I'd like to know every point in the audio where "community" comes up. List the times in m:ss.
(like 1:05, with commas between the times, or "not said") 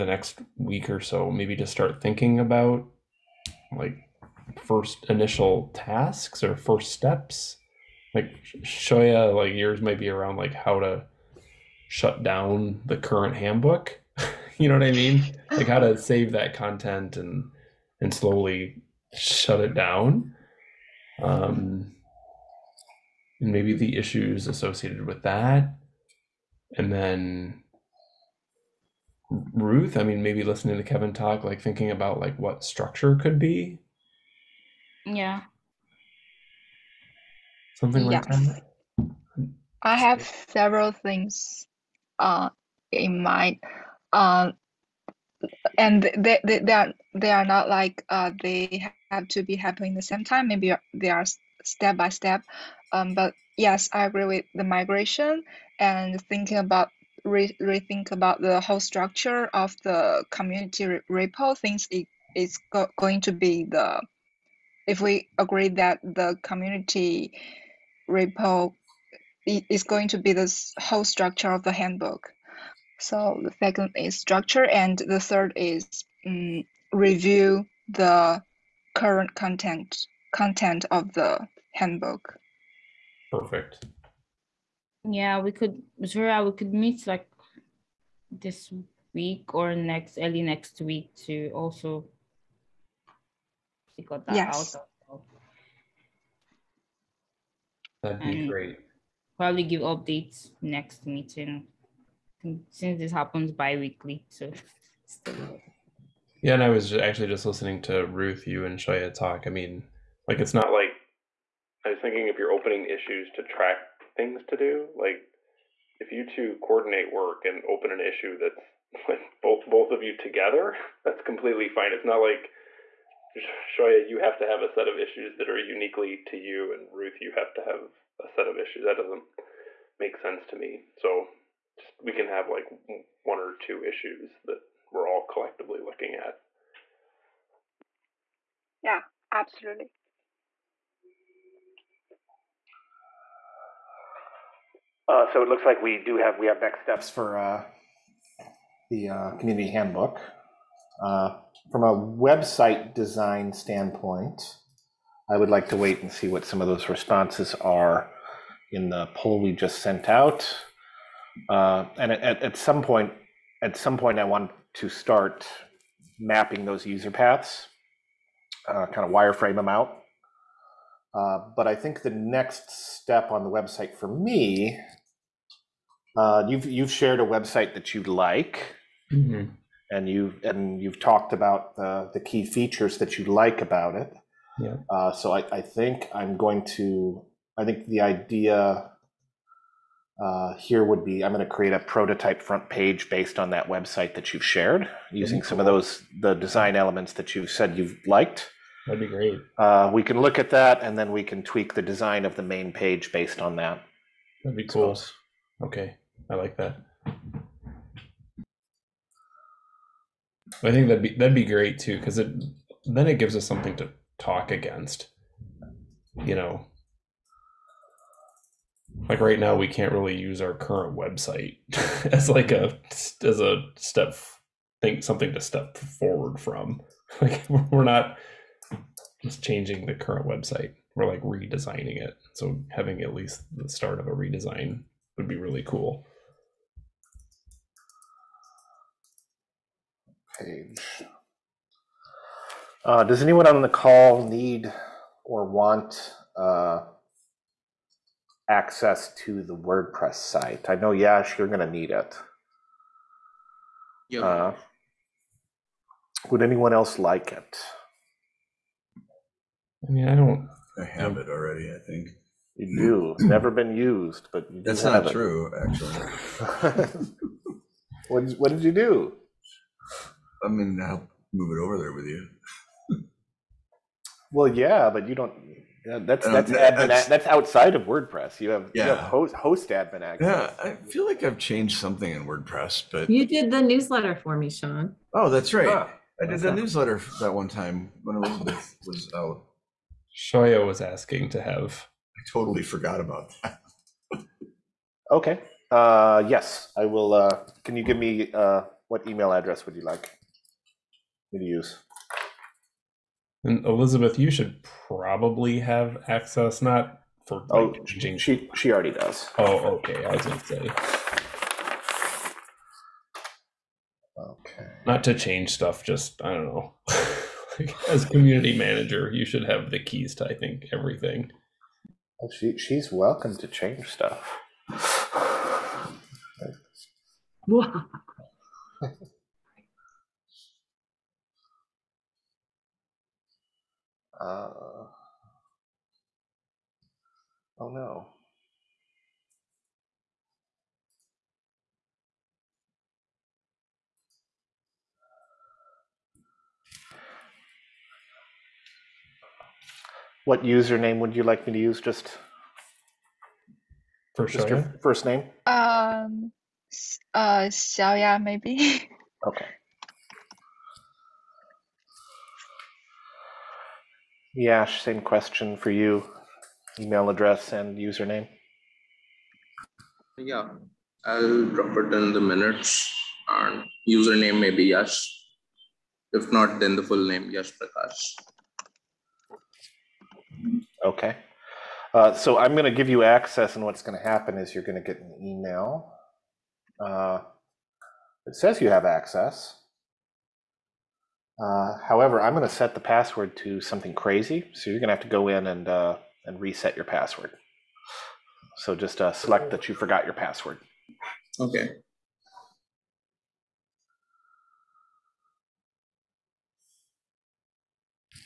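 1:00, 1:06, 2:29, 5:18.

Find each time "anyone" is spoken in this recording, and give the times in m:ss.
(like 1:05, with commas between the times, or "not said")
4:03, 4:16.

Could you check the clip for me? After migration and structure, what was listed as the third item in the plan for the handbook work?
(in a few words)
review the current content.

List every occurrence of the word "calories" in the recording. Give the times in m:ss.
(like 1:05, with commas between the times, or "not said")
not said.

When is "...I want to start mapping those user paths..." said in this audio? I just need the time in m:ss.
2:44.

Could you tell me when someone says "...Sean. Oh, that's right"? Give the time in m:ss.
4:44.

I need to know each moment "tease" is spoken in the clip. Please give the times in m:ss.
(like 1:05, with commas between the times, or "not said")
not said.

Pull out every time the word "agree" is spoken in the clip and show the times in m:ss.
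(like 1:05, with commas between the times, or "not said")
0:54, 1:05.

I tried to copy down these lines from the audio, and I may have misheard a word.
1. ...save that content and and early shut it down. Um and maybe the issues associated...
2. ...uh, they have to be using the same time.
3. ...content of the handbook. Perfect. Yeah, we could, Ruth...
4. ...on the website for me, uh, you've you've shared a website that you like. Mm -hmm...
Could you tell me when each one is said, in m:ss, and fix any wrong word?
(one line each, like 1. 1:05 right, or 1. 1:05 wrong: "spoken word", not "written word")
1. 0:15 wrong: "slowly", not "early"
2. 0:48 wrong: "happening", not "using"
3. 1:20 wrong: "Zura", not "Ruth"
4. 2:53 right.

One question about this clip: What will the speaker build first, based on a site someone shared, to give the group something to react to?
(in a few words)
a prototype front page.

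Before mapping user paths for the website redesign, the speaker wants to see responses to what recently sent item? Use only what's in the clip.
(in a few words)
the poll.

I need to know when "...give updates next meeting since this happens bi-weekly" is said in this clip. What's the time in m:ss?
1:39.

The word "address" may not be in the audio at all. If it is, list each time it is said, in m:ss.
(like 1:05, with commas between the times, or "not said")
4:59, 6:07.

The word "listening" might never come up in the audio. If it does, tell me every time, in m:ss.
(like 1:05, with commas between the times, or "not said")
0:30, 1:47.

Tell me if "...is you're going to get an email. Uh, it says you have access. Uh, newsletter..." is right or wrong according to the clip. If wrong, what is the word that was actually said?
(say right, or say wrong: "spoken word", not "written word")
wrong: "however", not "newsletter".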